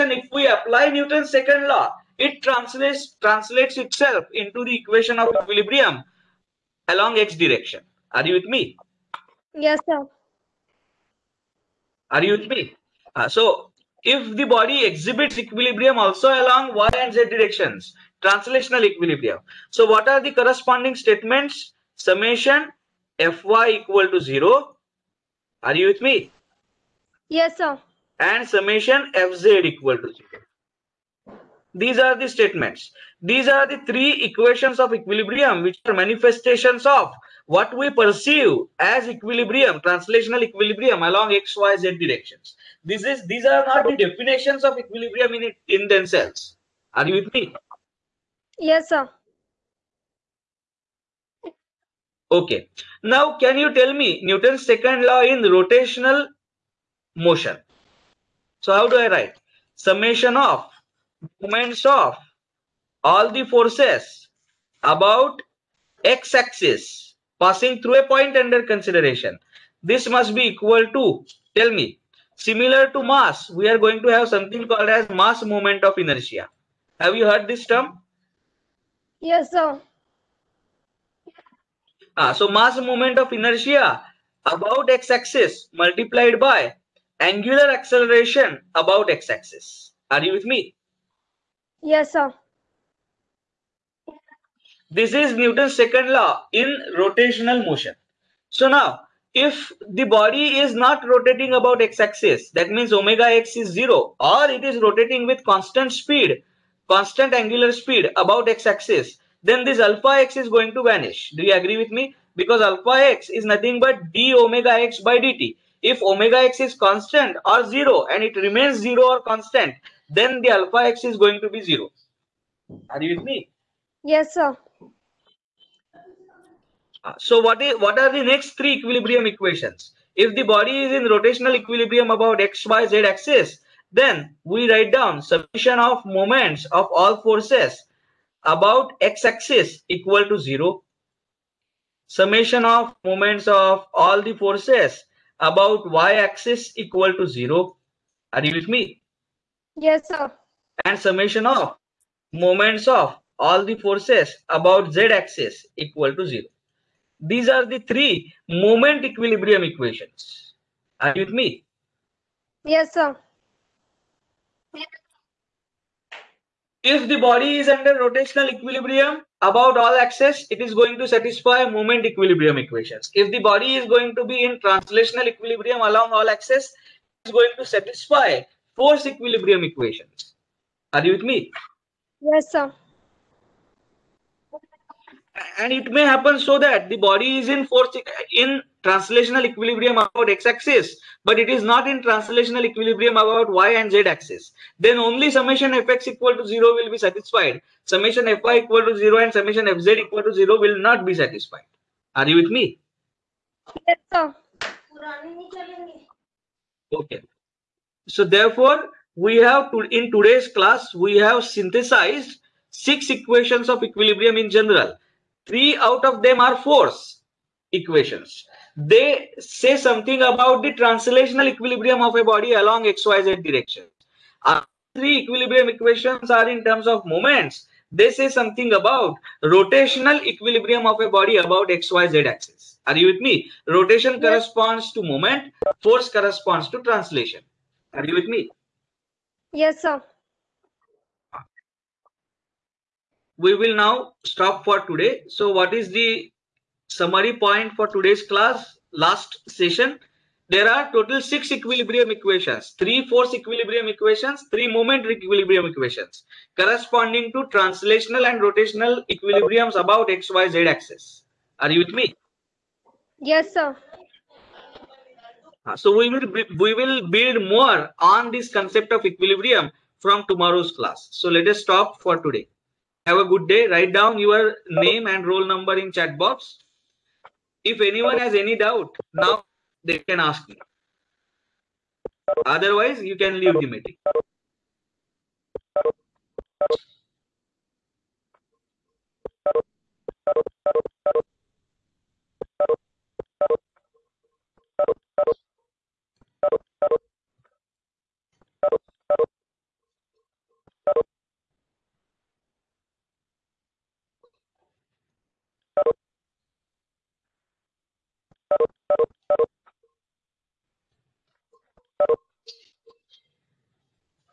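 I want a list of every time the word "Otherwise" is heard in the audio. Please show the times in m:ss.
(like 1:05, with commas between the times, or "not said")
4:42.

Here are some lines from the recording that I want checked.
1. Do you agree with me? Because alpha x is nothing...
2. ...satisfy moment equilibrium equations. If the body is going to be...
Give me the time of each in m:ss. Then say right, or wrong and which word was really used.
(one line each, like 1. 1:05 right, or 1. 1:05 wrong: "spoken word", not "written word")
1. 1:51 right
2. 2:51 right.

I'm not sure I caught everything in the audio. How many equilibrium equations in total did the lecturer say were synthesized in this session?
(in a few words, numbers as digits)
6.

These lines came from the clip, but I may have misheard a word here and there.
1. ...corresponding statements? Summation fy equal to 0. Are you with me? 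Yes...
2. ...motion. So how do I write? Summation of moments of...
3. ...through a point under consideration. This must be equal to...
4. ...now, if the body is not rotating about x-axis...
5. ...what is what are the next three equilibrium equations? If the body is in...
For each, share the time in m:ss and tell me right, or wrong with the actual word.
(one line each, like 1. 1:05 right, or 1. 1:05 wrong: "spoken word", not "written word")
1. 0:20 right
2. 0:57 right
3. 1:07 right
4. 1:38 right
5. 2:07 right.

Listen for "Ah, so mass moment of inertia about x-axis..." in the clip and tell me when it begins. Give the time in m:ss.
1:22.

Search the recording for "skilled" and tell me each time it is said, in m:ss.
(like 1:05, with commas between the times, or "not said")
not said.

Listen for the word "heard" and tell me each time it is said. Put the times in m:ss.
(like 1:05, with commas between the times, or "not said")
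1:17.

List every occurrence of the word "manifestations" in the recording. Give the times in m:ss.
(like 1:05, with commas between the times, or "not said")
0:35.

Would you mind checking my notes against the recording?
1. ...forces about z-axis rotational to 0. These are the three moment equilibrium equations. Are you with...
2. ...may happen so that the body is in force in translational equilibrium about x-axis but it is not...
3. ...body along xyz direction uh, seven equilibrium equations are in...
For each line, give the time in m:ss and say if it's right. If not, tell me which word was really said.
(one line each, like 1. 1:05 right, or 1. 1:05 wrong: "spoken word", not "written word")
1. 2:33 wrong: "equal", not "rotational"
2. 3:05 right
3. 3:42 wrong: "three", not "seven".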